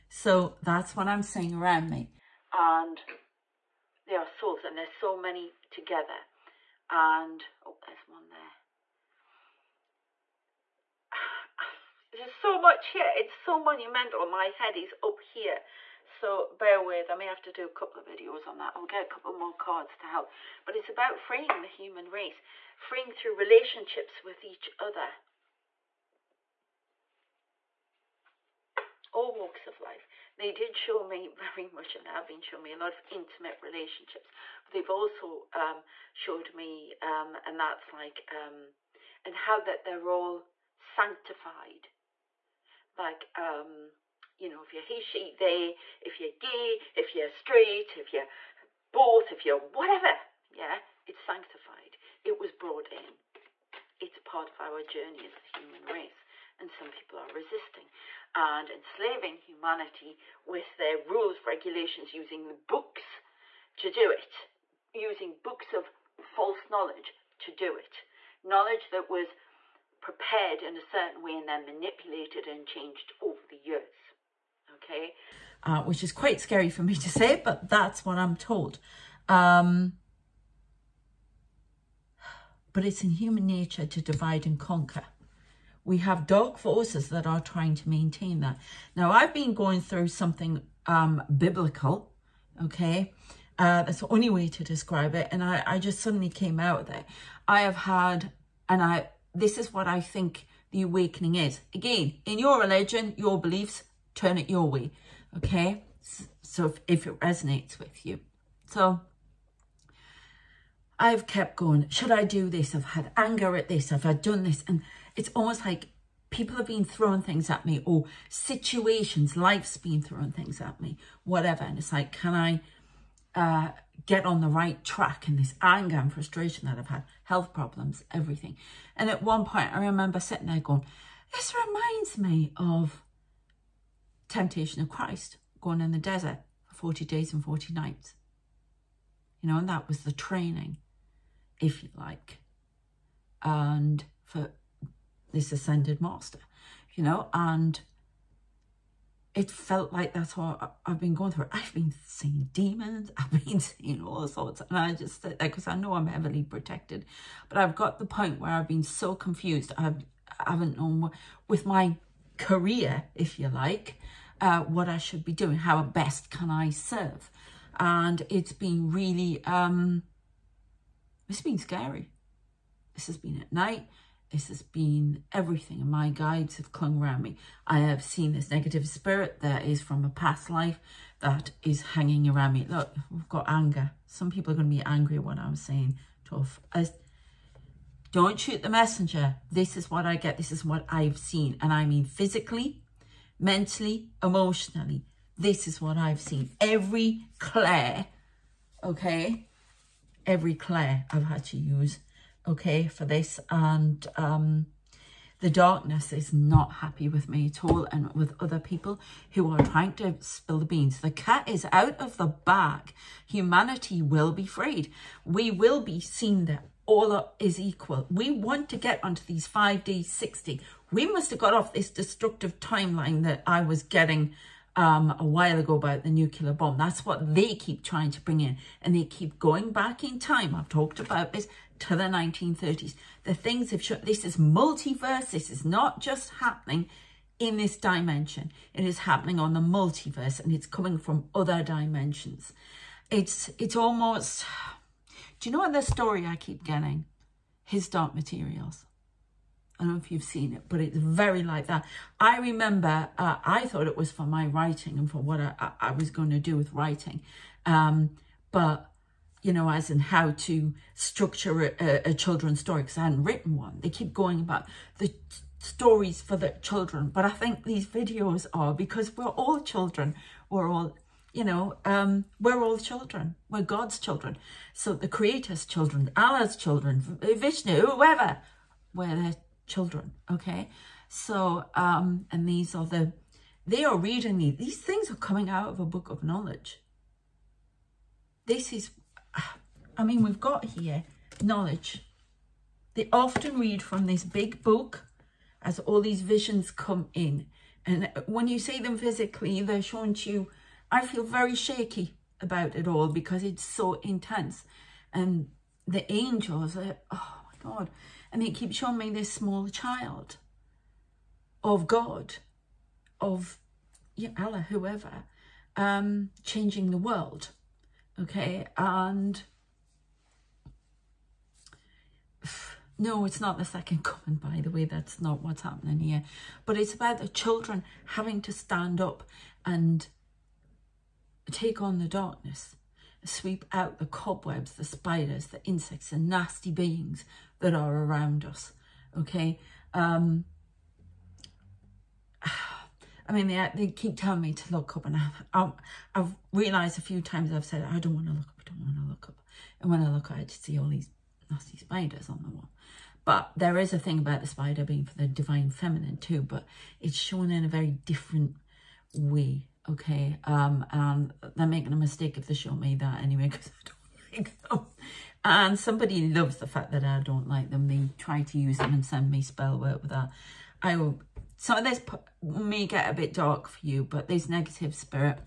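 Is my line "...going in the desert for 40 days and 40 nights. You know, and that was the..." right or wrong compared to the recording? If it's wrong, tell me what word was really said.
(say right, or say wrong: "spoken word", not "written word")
right.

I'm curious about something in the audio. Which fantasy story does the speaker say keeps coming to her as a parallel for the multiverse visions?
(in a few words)
His Dark Materials.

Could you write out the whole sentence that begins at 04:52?
They often read from this big book as all these visions come in.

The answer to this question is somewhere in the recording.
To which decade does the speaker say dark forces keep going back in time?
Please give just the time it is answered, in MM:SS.
03:52.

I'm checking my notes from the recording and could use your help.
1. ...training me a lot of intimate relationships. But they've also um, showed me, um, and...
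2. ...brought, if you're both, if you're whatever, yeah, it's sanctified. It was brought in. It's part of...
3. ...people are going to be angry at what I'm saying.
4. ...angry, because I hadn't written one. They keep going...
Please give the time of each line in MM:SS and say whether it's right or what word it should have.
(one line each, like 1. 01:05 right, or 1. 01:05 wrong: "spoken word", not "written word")
1. 00:32 wrong: "showing", not "training"
2. 00:47 wrong: "straight", not "brought"
3. 03:04 right
4. 04:22 wrong: "story", not "angry".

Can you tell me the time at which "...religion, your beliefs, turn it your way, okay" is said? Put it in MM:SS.
01:42.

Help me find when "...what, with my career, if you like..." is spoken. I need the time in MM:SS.
02:41.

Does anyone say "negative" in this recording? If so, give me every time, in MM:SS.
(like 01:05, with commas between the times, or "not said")
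02:58, 06:14.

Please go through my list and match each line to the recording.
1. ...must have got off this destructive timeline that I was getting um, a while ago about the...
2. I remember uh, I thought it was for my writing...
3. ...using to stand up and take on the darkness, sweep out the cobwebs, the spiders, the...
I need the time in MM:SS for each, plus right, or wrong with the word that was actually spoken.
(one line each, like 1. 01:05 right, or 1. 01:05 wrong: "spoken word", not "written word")
1. 03:41 right
2. 04:12 right
3. 05:28 wrong: "having", not "using".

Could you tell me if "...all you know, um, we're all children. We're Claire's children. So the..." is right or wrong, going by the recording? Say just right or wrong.
wrong.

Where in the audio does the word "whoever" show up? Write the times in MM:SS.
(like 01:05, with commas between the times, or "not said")
04:37, 05:14.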